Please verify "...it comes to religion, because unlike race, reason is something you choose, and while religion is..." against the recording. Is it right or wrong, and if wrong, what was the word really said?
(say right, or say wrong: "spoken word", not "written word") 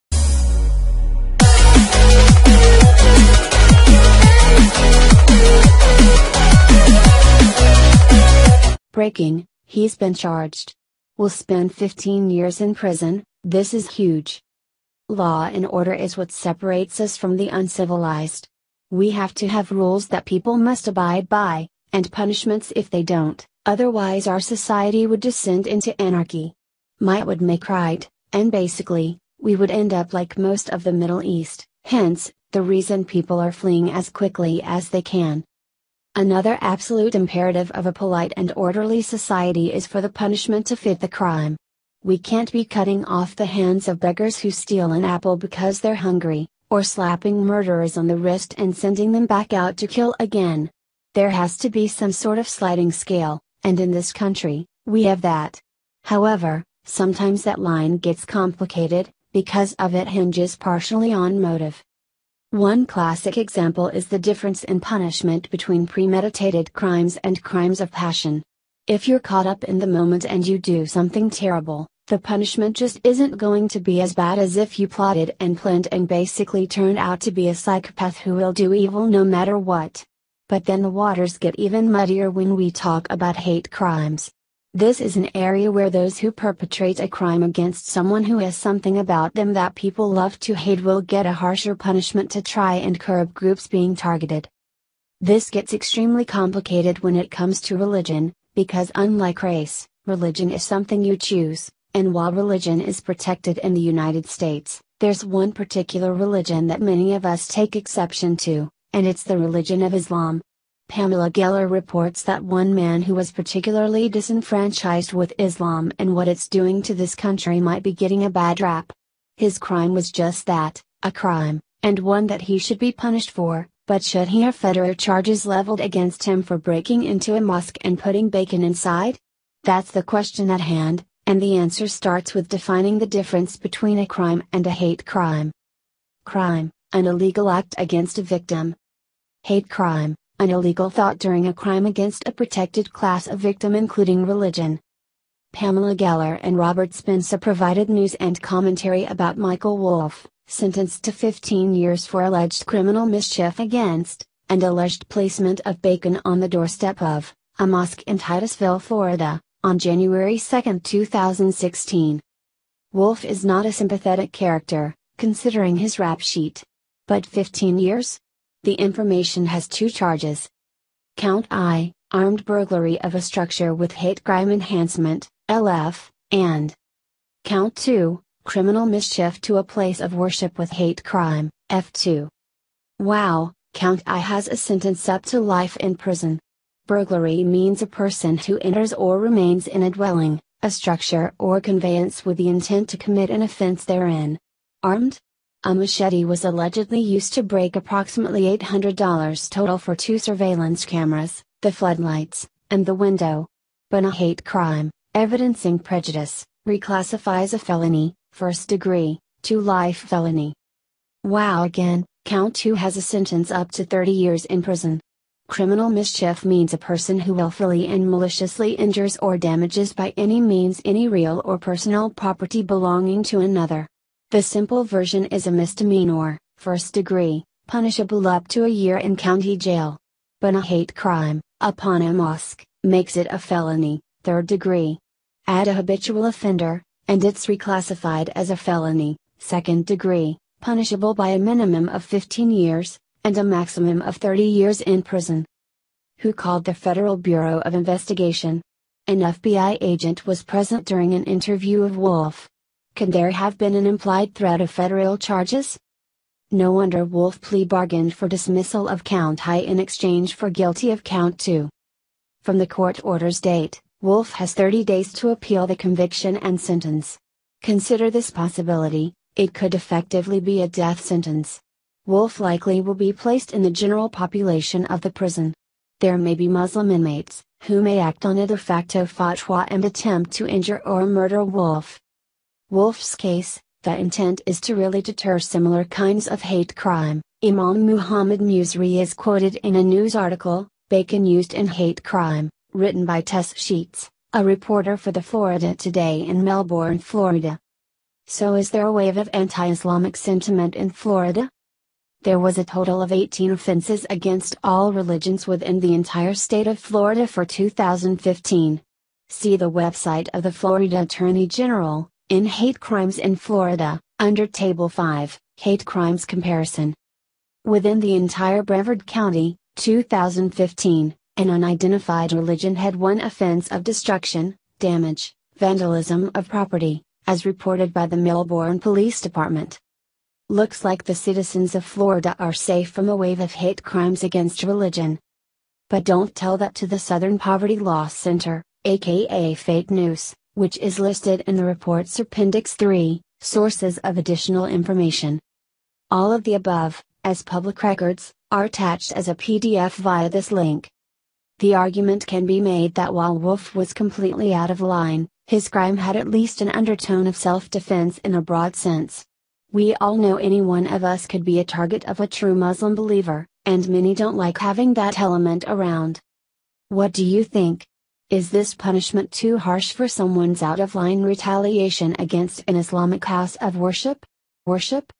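wrong: "religion", not "reason".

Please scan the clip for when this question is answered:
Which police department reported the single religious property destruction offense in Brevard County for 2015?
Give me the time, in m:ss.
5:28.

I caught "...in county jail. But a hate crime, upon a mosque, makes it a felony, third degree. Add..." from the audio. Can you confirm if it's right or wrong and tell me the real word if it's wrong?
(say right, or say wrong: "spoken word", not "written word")
right.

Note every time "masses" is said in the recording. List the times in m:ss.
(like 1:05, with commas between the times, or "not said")
not said.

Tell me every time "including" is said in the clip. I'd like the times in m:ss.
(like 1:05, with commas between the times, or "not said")
2:23.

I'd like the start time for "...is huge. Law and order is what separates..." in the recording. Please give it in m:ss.
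0:13.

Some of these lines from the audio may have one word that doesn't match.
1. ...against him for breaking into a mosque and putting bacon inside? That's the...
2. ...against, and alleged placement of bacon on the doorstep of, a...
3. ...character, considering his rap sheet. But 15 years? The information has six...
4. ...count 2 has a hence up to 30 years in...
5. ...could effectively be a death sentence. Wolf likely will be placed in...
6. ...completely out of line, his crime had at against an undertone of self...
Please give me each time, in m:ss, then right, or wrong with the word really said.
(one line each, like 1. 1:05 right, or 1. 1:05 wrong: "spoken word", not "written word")
1. 2:05 right
2. 2:33 right
3. 2:44 wrong: "two", not "six"
4. 3:32 wrong: "sentence", not "hence"
5. 4:29 right
6. 5:53 wrong: "least", not "against".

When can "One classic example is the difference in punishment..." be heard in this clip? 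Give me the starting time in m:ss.
1:02.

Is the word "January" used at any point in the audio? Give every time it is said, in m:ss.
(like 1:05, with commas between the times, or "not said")
2:39.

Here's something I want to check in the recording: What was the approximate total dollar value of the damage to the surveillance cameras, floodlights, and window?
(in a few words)
$800.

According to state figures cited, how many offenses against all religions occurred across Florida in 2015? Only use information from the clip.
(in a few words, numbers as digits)
18.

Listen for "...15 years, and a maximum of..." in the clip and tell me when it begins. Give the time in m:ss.
4:02.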